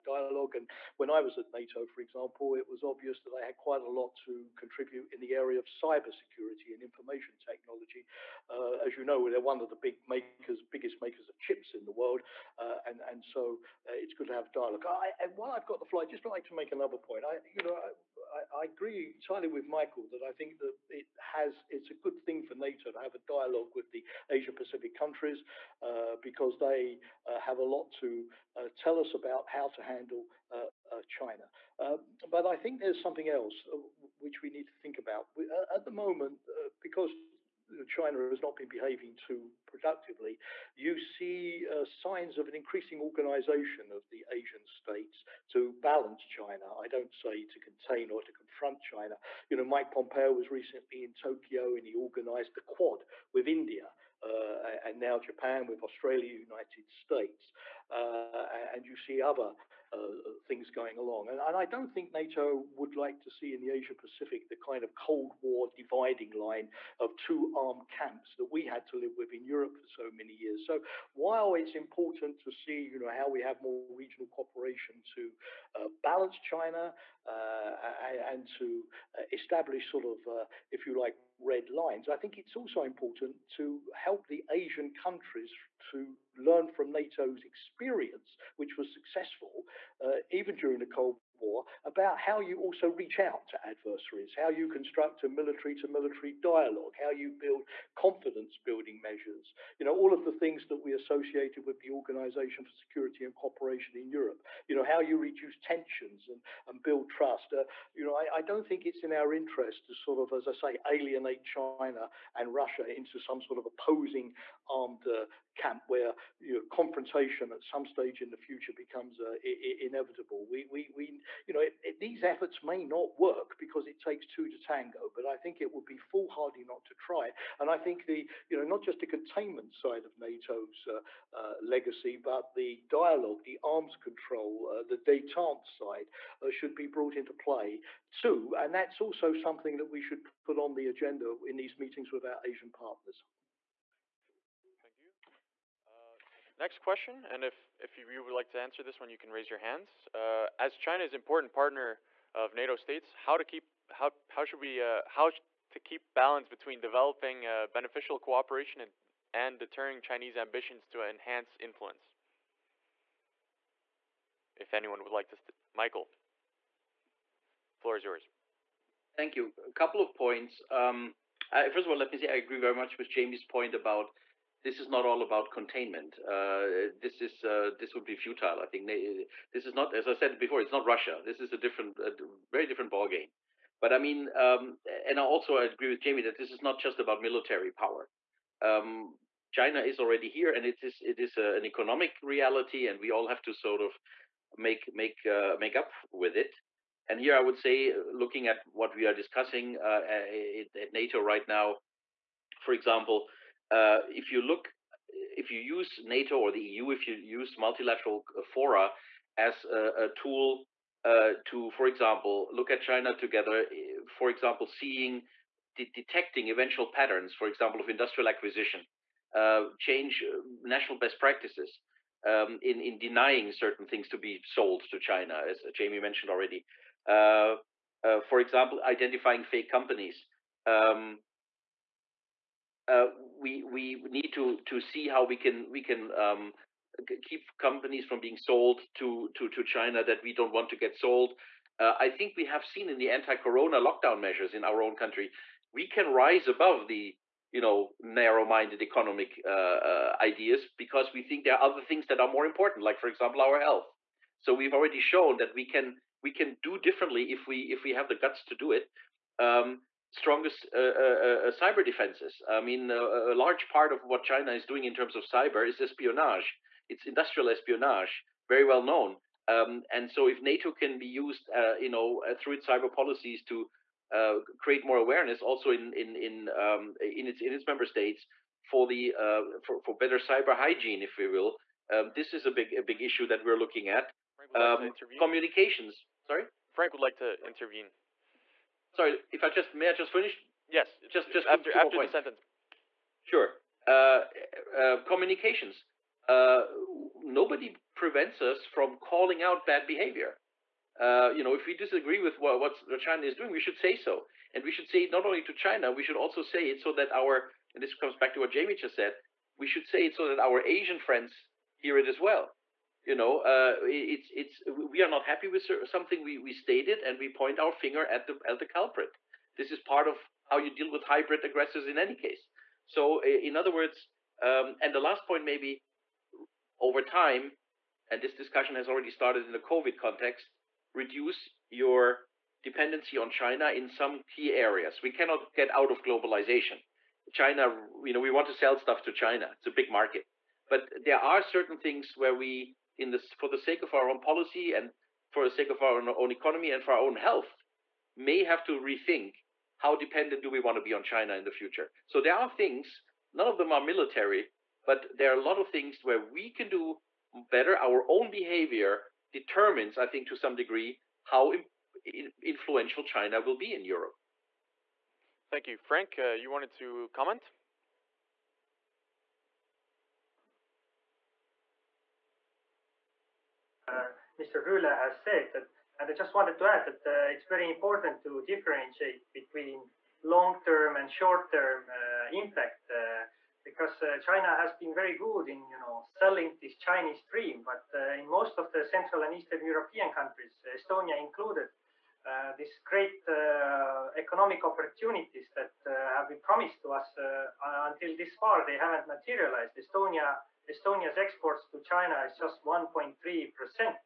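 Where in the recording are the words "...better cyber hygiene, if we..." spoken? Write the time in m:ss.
4:40.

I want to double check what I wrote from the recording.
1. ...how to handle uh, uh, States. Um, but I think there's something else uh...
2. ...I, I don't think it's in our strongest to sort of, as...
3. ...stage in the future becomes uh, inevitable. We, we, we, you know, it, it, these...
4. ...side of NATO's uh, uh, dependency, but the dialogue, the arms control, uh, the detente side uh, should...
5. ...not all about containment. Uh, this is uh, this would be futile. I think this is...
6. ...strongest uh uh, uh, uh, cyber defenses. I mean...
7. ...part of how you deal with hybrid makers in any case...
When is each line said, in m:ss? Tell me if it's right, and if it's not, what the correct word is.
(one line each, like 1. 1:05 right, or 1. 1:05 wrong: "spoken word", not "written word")
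1. 0:29 wrong: "China", not "States"
2. 1:48 wrong: "interest", not "strongest"
3. 1:57 right
4. 2:09 wrong: "legacy", not "dependency"
5. 2:54 right
6. 4:20 right
7. 5:19 wrong: "aggressors", not "makers".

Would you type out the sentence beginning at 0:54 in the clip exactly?
Uh, and now Japan with Australia, United States, uh, and you see other uh, things going along.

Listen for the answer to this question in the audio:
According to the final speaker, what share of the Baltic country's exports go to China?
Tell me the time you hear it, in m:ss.
6:42.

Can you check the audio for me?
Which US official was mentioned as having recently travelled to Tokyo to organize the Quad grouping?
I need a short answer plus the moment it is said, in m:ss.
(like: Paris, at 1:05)
Mike Pompeo, at 0:49.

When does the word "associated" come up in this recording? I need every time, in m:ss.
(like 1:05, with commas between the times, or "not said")
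1:40.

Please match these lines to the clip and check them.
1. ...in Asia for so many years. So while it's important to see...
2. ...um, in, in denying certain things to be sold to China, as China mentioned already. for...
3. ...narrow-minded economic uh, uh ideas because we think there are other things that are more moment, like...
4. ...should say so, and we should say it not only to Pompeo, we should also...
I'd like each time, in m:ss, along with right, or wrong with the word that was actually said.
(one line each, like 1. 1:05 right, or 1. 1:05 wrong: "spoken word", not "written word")
1. 1:09 wrong: "Europe", not "Asia"
2. 3:42 wrong: "Jamie", not "China"
3. 4:08 wrong: "important", not "moment"
4. 5:03 wrong: "China", not "Pompeo".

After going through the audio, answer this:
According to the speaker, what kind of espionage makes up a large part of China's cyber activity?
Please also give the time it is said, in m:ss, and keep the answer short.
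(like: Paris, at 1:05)
Industrial espionage, at 4:27.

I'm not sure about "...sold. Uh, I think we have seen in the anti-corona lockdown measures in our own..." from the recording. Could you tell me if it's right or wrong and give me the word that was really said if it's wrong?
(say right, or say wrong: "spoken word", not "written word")
right.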